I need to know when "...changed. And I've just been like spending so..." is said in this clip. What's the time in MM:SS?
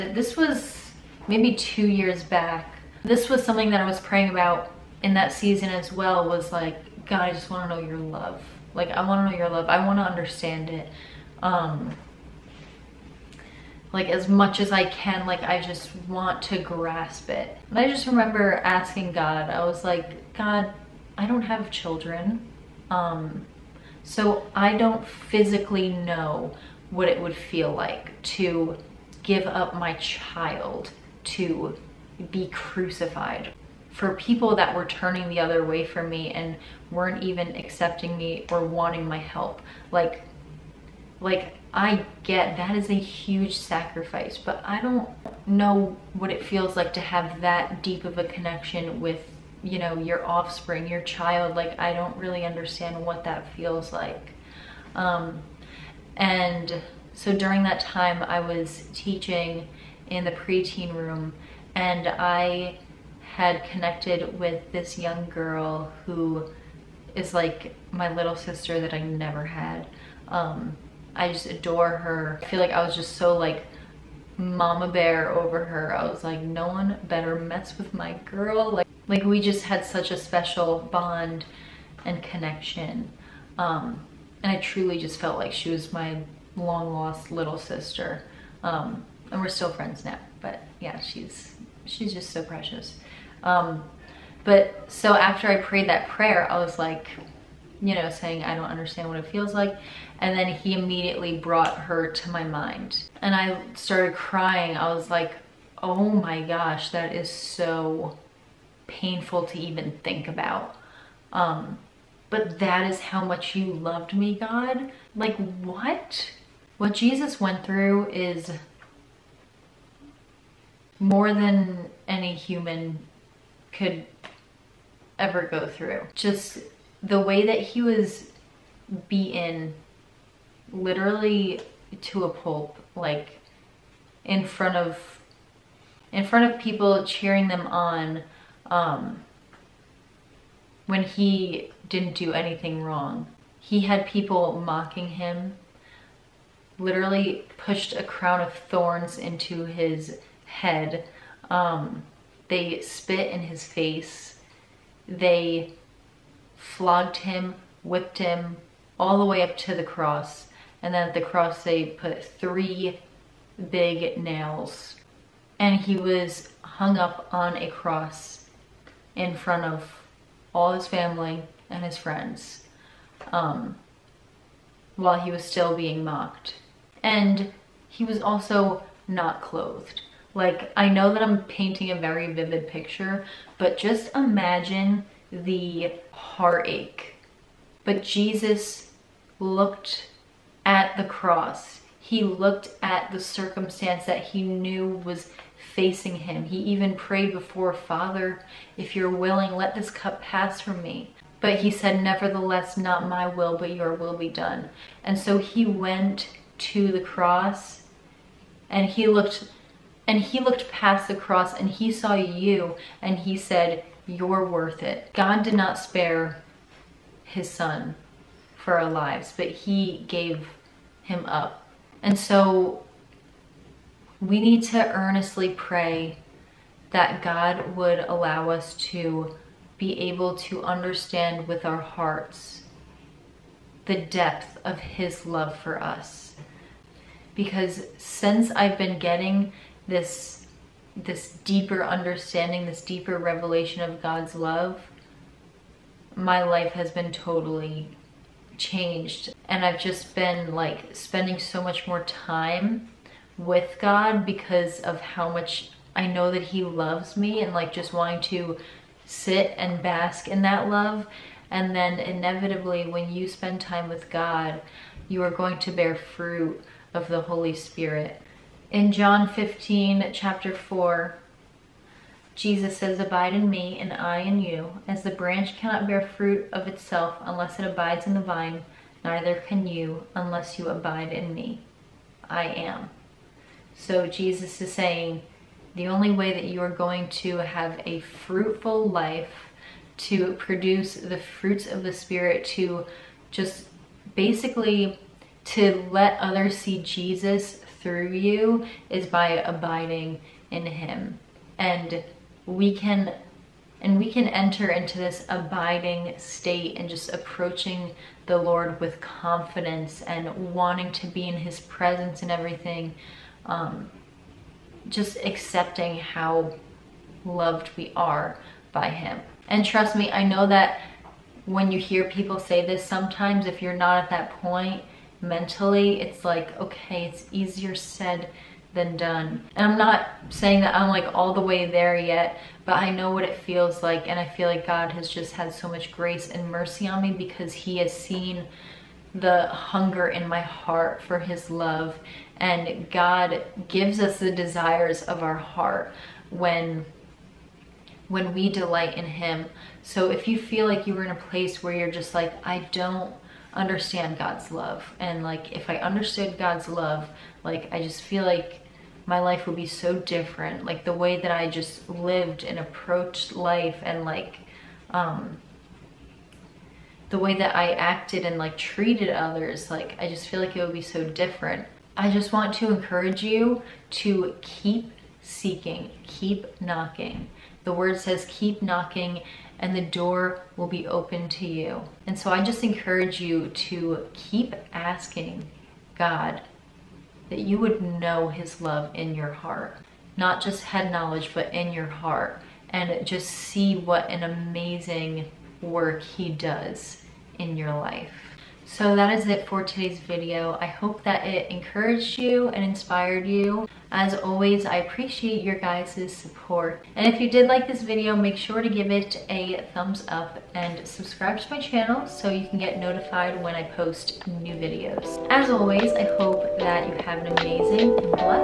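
04:08.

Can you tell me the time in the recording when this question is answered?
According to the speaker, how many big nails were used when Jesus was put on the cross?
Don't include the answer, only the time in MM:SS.
02:42.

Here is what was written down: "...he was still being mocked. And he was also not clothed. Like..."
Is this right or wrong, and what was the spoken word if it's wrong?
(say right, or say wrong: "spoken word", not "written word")
right.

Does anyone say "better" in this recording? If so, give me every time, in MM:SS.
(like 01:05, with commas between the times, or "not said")
01:17.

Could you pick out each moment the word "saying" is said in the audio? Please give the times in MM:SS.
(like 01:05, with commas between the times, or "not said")
01:38, 04:44, 05:30.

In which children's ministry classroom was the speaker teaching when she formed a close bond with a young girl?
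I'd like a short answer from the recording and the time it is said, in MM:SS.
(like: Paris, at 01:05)
Preteen room, at 01:00.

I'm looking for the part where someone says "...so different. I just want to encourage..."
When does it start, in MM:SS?
06:10.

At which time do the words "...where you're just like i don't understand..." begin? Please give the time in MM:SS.
05:51.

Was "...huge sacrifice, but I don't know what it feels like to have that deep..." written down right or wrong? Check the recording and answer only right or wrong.
right.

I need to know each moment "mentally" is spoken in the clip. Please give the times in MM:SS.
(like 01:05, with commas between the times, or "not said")
05:25.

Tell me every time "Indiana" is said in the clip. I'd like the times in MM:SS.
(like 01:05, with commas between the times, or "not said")
not said.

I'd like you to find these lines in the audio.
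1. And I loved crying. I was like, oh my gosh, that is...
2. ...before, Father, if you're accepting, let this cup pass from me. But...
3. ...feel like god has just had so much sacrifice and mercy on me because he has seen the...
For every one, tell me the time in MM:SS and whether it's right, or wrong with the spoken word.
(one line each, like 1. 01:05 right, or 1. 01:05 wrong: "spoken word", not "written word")
1. 01:43 wrong: "started", not "loved"
2. 03:17 wrong: "willing", not "accepting"
3. 05:34 wrong: "grace", not "sacrifice".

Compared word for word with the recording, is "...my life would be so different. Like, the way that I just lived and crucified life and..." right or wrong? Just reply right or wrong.
wrong.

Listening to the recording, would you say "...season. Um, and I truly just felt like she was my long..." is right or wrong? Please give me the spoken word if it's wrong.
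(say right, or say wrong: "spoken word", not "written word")
wrong: "connection", not "season".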